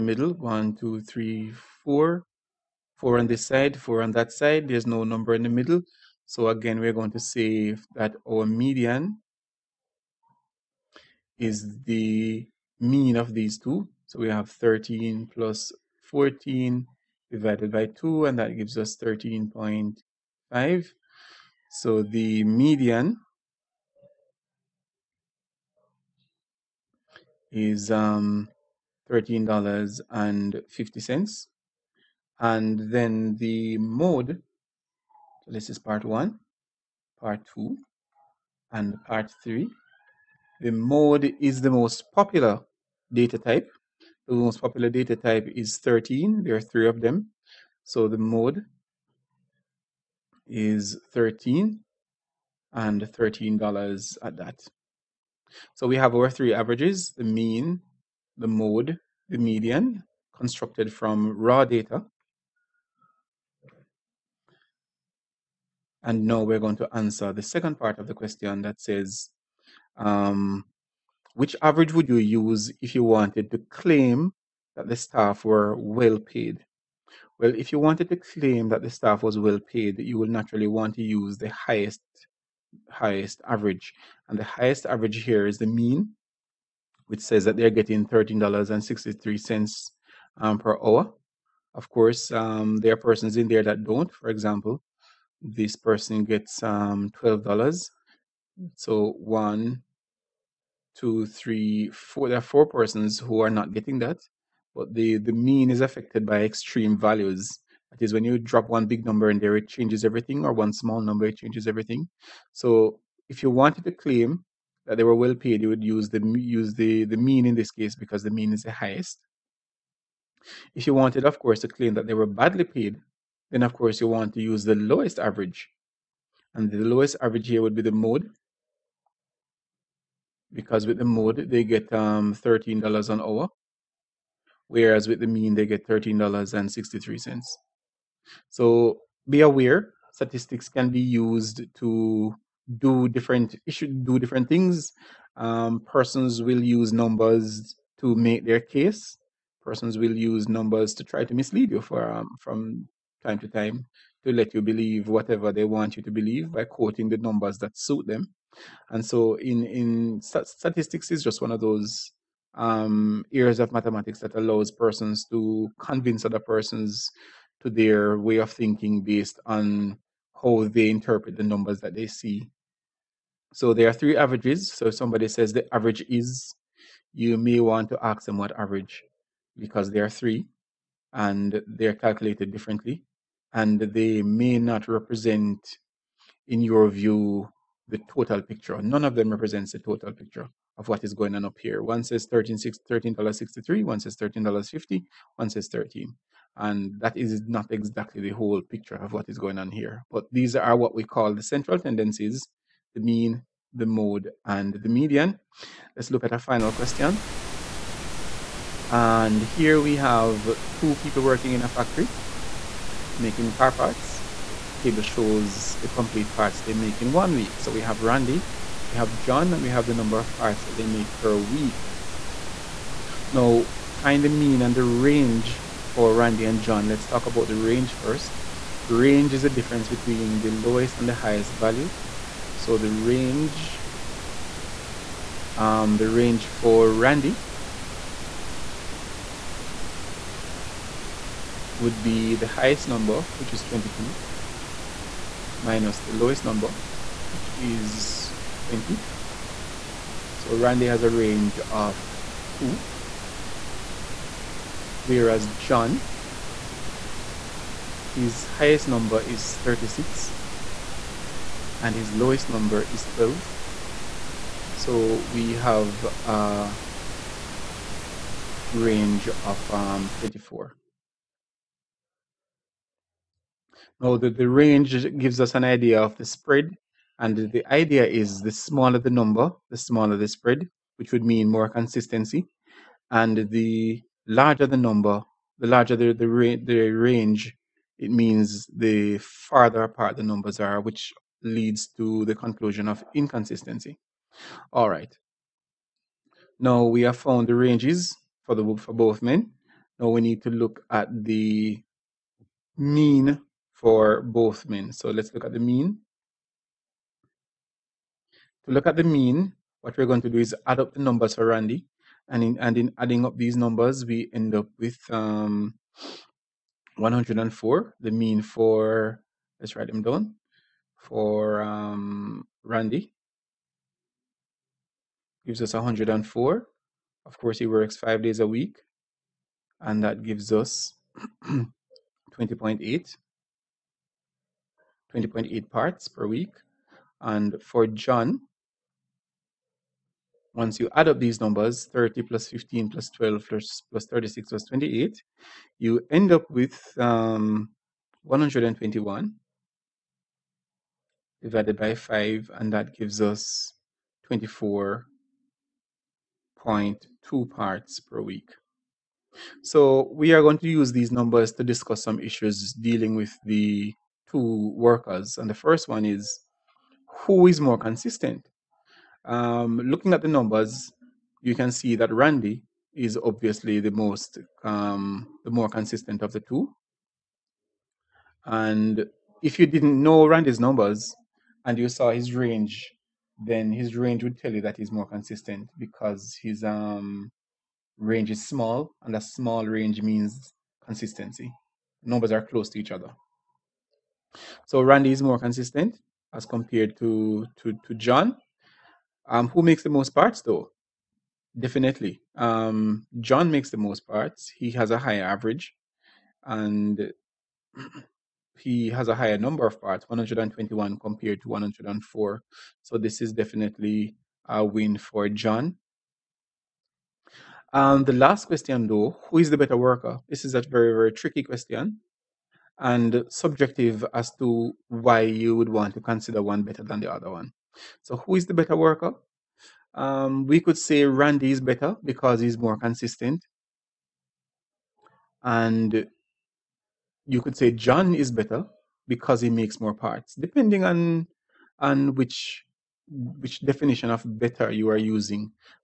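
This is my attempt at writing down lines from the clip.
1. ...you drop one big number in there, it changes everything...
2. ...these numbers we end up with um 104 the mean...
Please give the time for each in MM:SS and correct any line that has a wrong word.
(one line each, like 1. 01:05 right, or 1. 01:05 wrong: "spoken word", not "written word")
1. 01:48 right
2. 05:13 right.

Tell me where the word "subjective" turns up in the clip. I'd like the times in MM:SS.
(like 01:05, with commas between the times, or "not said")
07:03.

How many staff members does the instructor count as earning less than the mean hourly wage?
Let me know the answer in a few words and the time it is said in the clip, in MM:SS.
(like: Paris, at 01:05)
4, at 01:42.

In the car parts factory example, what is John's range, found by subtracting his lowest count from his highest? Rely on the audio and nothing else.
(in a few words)
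24.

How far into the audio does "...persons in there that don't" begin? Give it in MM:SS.
01:32.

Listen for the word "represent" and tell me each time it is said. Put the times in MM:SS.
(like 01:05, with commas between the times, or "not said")
03:04, 03:09.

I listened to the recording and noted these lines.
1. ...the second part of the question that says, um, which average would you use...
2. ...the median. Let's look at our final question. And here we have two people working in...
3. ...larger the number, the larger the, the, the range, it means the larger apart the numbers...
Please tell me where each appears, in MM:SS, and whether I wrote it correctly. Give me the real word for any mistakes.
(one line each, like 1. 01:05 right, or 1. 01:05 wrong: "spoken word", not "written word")
1. 01:07 right
2. 03:24 right
3. 04:44 wrong: "farther", not "larger".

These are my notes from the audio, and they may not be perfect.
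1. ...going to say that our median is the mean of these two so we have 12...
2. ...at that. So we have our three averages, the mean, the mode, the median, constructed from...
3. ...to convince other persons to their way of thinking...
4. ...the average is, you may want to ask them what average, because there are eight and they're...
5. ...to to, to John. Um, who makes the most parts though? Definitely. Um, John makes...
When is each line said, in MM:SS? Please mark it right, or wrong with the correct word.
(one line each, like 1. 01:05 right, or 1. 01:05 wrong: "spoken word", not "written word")
1. 00:06 wrong: "13", not "12"
2. 00:54 right
3. 02:45 right
4. 02:55 wrong: "three", not "eight"
5. 06:36 right.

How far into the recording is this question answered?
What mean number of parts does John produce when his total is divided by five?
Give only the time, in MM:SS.
05:54.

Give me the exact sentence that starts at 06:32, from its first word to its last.
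Numbers are close to each other.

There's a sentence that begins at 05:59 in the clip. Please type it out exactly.
So we are going to use these numbers to discuss some issues dealing with the two workers.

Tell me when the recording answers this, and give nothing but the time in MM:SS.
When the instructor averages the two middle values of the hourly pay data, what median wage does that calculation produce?
00:18.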